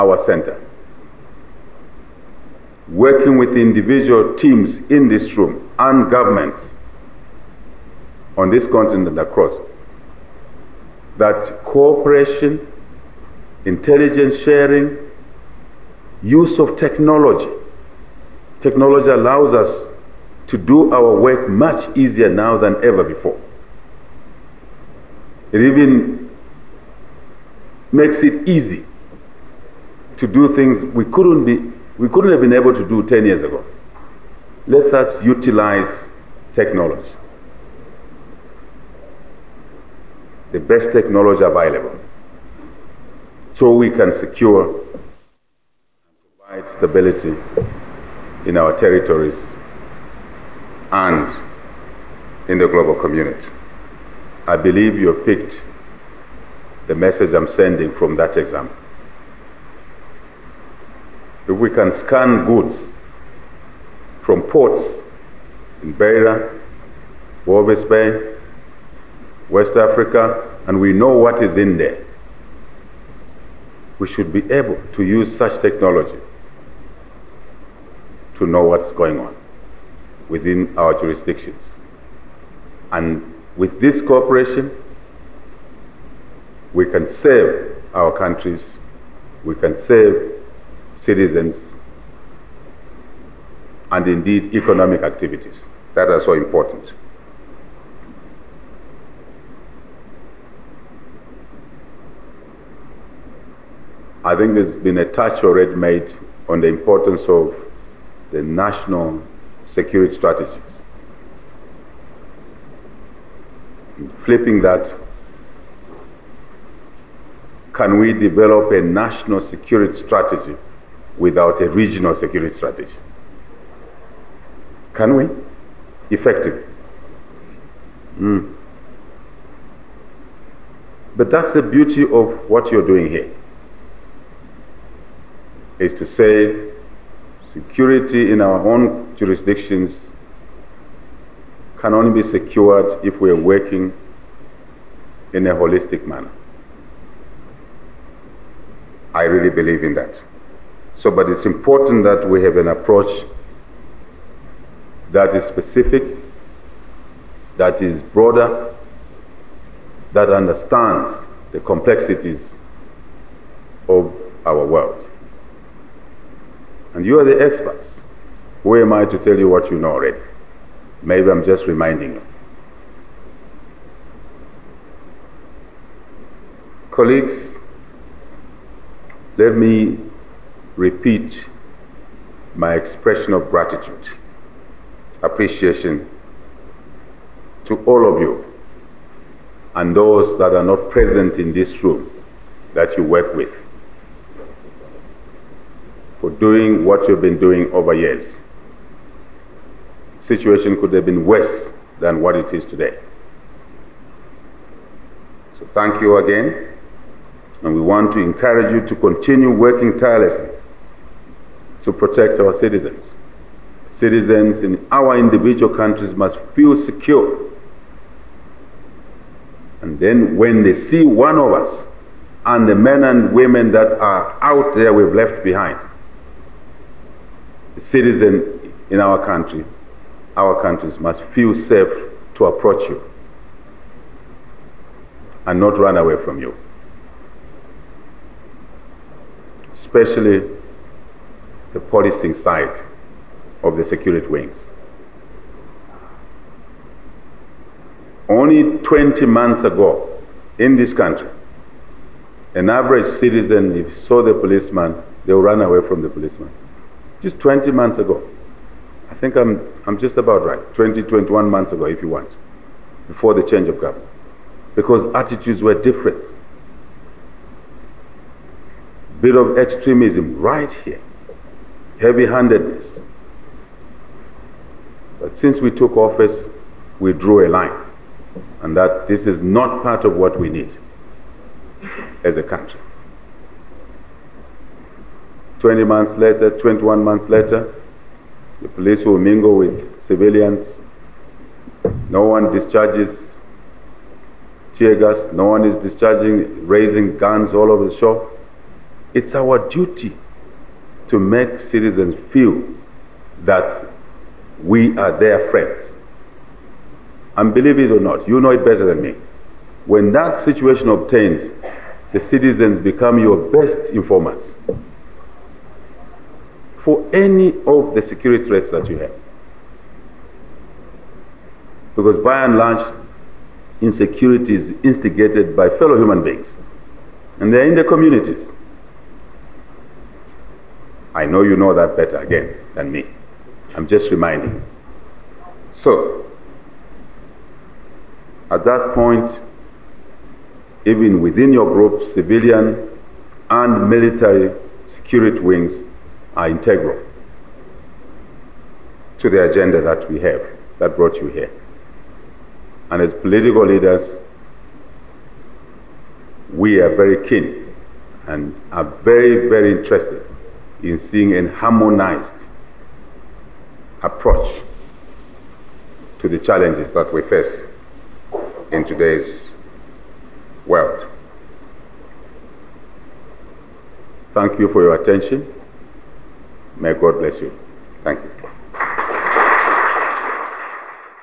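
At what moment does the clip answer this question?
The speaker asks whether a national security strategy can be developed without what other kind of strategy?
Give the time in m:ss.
2:01.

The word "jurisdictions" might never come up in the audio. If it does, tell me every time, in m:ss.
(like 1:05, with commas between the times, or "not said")
1:20, 2:19.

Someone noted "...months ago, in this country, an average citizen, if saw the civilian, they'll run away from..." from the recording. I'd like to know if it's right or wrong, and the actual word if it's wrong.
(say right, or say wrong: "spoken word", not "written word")
wrong: "policeman", not "civilian".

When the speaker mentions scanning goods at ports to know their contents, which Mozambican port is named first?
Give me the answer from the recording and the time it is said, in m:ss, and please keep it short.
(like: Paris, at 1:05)
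Beira, at 1:05.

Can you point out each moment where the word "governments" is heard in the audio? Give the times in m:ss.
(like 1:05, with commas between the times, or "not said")
0:06, 4:23.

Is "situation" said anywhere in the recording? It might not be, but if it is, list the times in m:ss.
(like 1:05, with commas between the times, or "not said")
3:20, 5:10.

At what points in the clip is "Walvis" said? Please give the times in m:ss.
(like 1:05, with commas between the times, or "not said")
1:07.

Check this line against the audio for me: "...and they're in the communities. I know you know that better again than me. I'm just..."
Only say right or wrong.
right.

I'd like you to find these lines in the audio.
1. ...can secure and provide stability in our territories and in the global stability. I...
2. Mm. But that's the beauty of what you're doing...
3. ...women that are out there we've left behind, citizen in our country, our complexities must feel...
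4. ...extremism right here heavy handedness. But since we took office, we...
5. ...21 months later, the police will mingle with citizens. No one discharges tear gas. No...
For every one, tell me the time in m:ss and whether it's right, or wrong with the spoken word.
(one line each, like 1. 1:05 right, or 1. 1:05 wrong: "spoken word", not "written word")
1. 0:43 wrong: "community", not "stability"
2. 2:08 right
3. 3:43 wrong: "countries", not "complexities"
4. 4:29 right
5. 4:46 wrong: "civilians", not "citizens".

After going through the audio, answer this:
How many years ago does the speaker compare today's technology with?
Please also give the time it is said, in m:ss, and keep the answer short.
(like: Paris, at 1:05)
10, at 0:33.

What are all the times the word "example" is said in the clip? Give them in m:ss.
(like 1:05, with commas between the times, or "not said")
0:58.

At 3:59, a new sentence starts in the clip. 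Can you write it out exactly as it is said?
Especially the policing side of the security wings.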